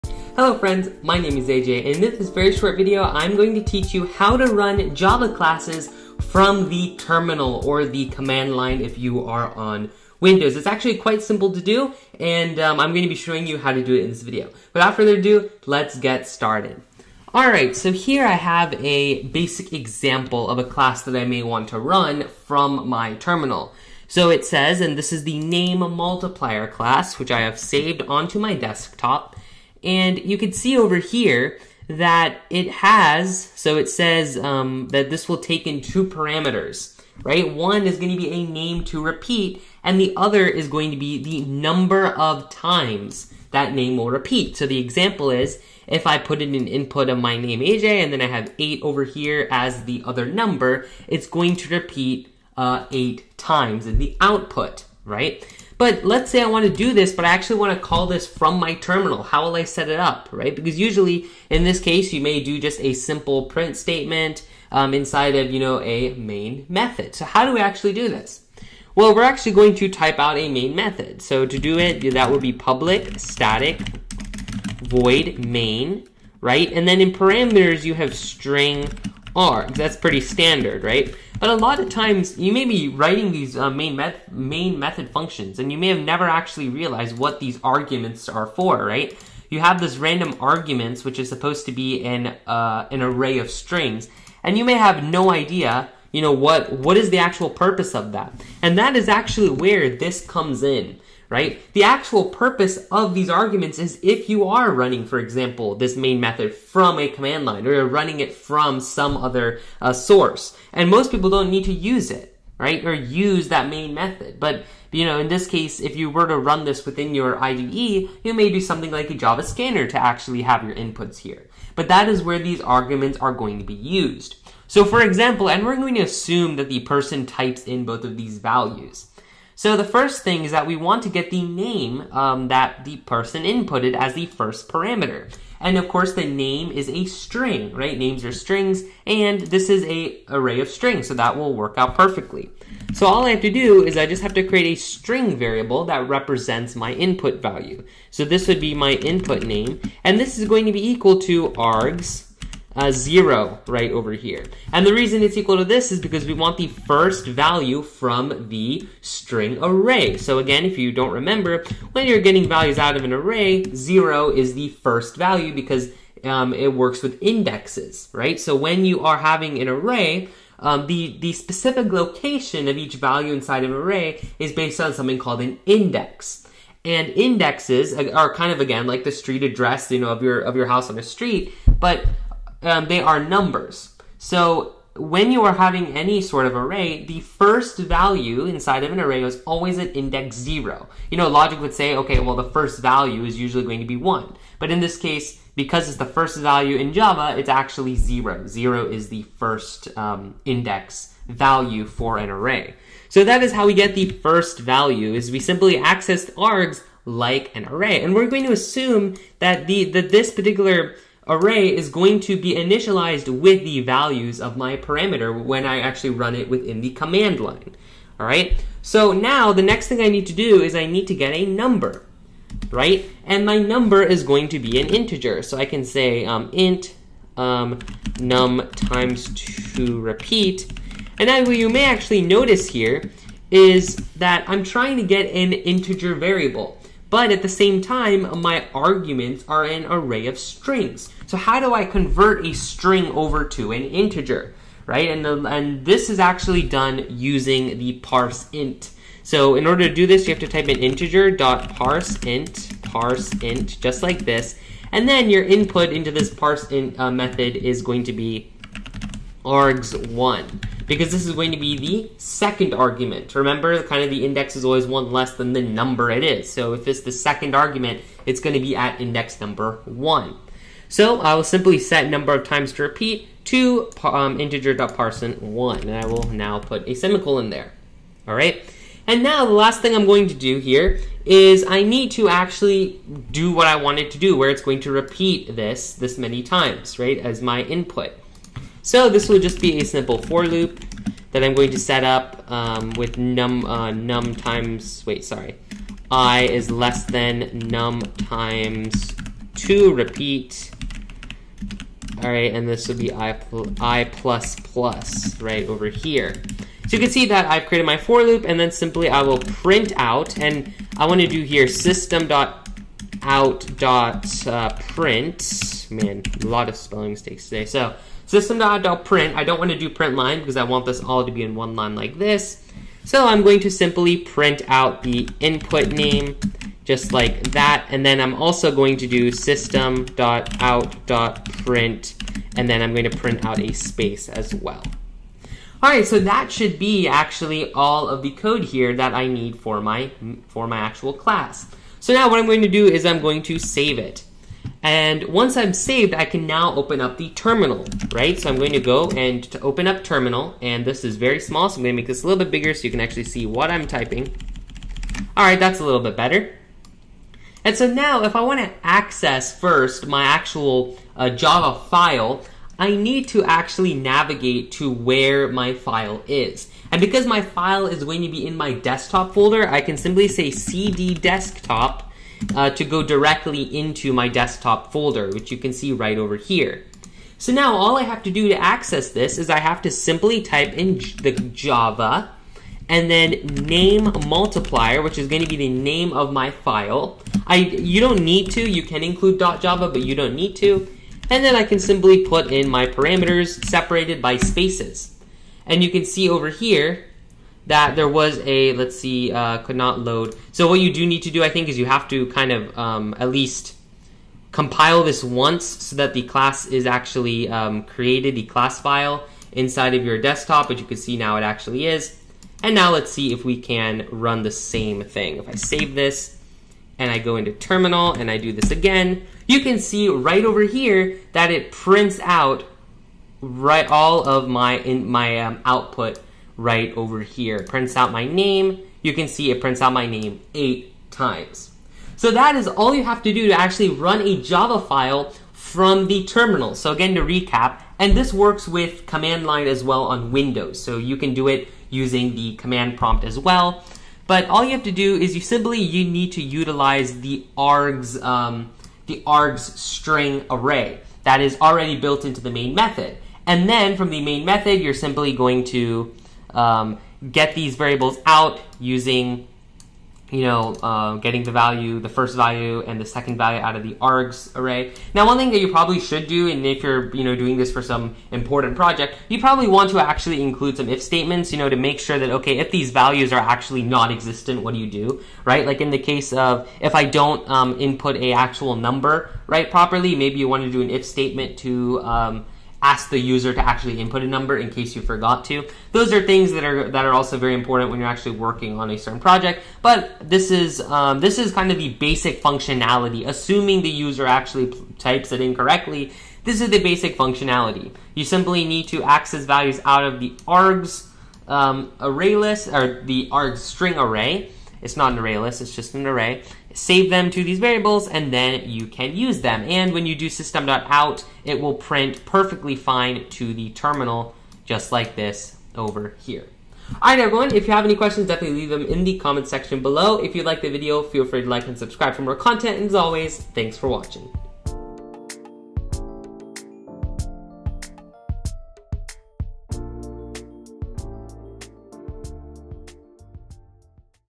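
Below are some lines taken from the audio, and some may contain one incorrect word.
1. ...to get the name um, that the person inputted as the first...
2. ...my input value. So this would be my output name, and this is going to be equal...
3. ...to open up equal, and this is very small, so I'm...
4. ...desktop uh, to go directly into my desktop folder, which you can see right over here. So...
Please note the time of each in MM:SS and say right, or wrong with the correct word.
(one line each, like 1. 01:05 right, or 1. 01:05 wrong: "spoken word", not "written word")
1. 02:11 right
2. 02:26 wrong: "input", not "output"
3. 05:49 wrong: "terminal", not "equal"
4. 06:11 right.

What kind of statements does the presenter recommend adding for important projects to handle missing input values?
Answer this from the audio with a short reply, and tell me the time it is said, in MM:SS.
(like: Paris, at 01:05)
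if statements, at 07:50.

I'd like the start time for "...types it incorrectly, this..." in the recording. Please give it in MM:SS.
08:14.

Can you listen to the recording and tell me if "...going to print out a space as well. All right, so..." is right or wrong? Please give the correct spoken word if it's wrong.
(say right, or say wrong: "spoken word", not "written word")
right.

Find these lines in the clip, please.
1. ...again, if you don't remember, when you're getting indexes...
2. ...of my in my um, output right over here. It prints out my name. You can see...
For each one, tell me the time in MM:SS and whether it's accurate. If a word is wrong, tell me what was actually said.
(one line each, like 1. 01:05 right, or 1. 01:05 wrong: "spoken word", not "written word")
1. 02:40 wrong: "values", not "indexes"
2. 07:04 right.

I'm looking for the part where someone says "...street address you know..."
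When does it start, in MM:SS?
02:59.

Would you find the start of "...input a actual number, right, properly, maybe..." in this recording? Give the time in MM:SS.
07:57.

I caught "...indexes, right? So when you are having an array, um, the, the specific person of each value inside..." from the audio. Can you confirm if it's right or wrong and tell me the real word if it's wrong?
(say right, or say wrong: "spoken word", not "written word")
wrong: "location", not "person".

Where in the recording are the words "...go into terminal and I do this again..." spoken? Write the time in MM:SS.
06:57.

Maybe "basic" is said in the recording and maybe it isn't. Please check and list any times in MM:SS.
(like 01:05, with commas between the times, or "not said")
00:19, 08:11, 08:16.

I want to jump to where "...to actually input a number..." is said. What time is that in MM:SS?
08:03.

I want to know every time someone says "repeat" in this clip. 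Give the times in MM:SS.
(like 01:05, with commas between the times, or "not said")
00:39, 00:44, 00:51, 03:49, 04:32, 04:44, 04:59.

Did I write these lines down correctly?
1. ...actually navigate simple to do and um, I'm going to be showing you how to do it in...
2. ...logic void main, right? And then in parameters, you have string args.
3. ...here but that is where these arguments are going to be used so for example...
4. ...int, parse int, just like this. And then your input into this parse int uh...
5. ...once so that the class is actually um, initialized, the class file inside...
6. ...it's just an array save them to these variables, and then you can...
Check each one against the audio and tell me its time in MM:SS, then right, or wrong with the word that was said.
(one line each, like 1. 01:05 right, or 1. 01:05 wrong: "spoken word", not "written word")
1. 00:10 wrong: "quite", not "navigate"
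2. 01:13 wrong: "static", not "logic"
3. 02:01 right
4. 04:12 right
5. 06:45 wrong: "created", not "initialized"
6. 08:25 right.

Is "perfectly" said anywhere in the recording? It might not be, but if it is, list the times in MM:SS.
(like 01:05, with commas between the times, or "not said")
02:21, 08:32.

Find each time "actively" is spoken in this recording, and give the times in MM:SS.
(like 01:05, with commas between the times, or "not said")
not said.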